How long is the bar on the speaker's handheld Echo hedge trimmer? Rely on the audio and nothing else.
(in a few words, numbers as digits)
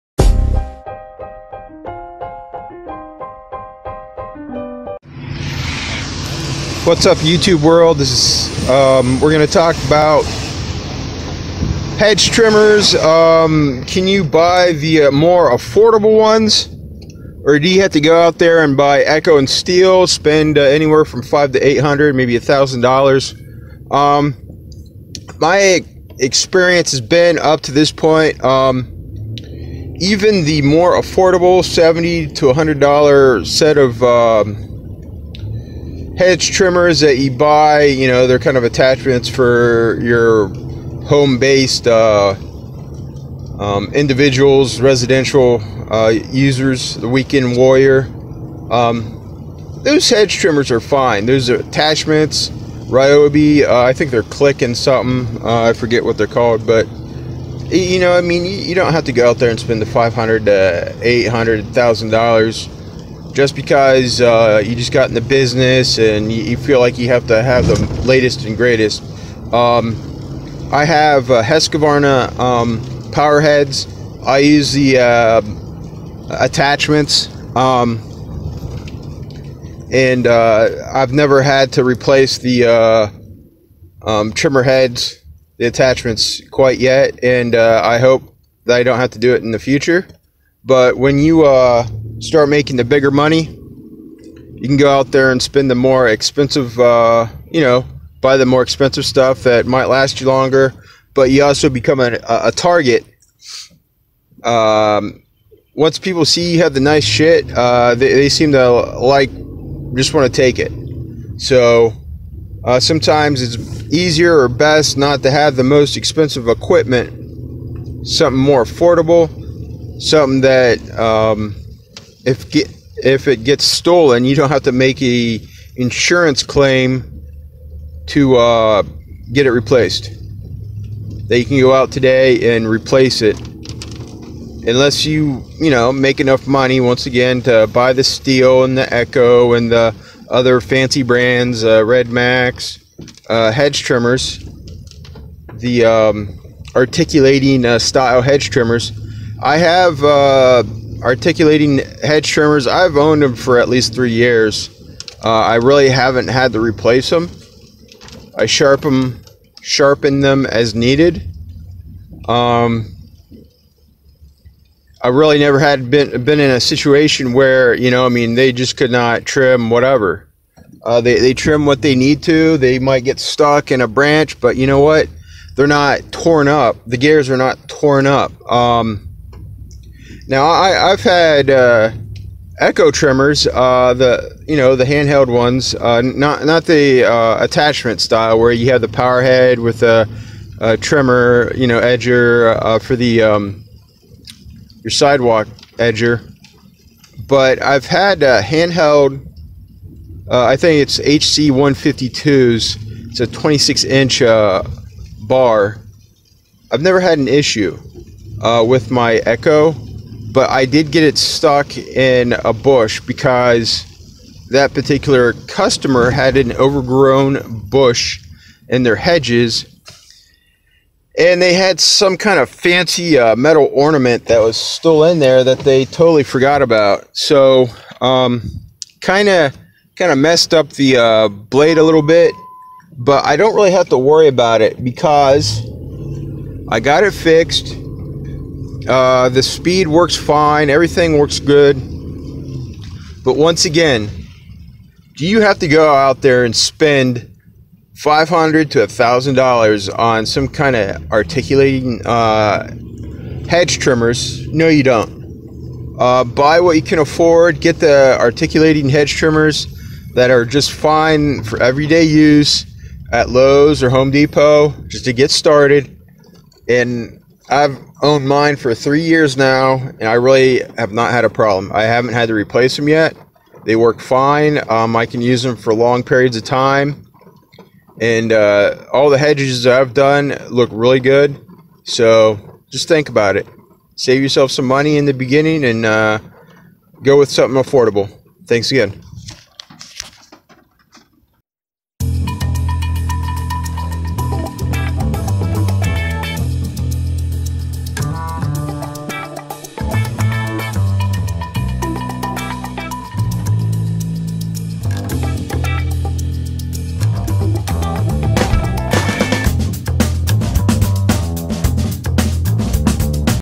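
26 inches.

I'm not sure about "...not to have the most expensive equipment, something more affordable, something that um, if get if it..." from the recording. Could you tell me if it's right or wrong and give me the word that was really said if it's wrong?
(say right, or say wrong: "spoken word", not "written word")
right.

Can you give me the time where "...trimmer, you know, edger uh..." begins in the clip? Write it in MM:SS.
03:10.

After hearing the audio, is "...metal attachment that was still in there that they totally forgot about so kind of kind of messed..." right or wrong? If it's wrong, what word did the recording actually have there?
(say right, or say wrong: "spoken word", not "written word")
wrong: "ornament", not "attachment".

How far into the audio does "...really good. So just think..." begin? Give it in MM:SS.
04:40.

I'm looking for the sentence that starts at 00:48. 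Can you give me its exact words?
Um, those hedge trimmers are fine.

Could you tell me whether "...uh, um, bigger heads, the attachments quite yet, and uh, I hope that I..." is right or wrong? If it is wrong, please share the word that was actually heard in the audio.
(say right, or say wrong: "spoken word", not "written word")
wrong: "trimmer", not "bigger".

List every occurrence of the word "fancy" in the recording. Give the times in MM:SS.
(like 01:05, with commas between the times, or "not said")
02:20, 03:42.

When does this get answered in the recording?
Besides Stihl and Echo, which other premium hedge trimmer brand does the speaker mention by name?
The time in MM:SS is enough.
02:21.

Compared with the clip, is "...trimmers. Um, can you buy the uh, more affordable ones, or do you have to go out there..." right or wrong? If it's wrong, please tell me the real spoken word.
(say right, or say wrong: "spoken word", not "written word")
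right.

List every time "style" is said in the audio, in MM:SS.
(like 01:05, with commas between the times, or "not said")
02:27, 03:07.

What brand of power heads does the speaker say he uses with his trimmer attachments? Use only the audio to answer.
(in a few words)
Husqvarna.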